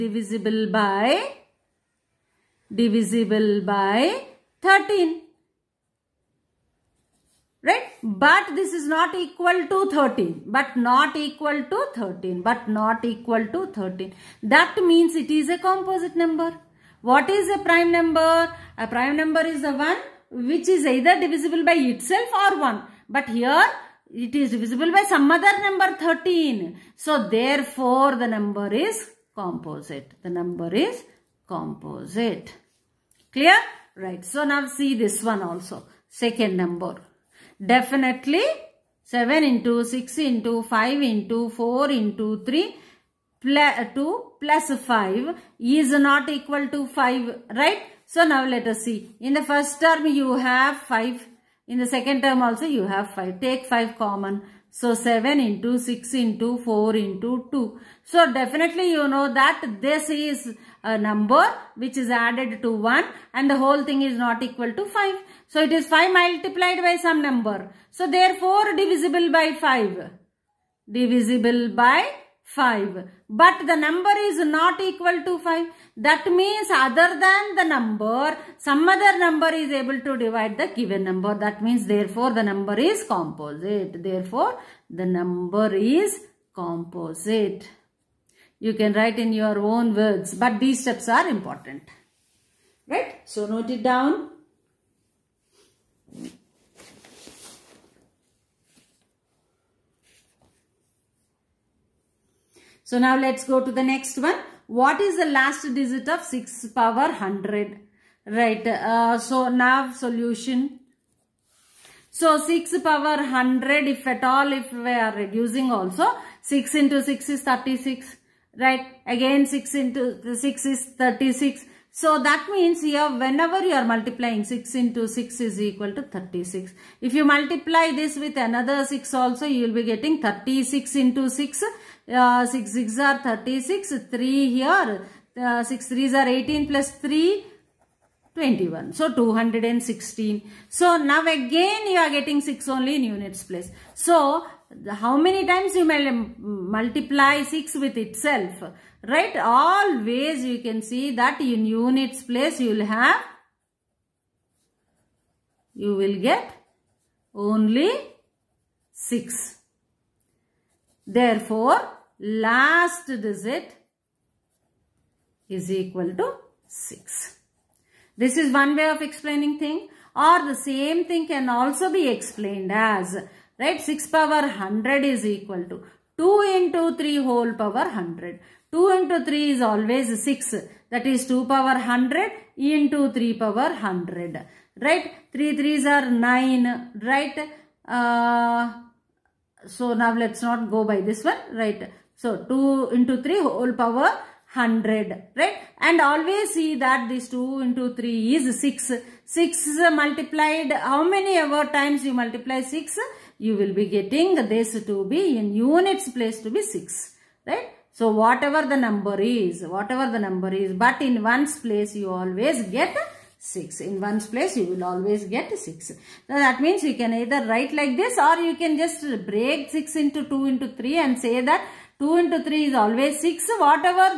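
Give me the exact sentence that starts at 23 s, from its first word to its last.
But here it is divisible by some other number 13.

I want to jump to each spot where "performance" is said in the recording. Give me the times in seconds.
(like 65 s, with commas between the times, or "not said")
not said.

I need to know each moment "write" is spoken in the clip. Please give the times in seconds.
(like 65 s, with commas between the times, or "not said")
88 s, 217 s.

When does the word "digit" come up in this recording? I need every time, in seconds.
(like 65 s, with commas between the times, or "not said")
105 s, 163 s.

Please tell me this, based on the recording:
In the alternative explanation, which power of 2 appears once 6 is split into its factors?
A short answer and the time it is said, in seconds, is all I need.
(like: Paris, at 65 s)
2 power 100, at 181 s.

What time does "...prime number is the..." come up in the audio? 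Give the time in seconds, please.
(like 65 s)
18 s.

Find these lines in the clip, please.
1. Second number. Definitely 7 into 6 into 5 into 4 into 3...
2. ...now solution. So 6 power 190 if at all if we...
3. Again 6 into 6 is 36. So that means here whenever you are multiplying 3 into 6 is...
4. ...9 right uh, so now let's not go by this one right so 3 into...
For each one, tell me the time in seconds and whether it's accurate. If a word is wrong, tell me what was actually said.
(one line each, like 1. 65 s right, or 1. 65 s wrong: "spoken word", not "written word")
1. 36 s right
2. 109 s wrong: "100", not "190"
3. 119 s wrong: "6", not "3"
4. 186 s wrong: "2", not "3".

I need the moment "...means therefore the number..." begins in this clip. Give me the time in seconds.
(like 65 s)
81 s.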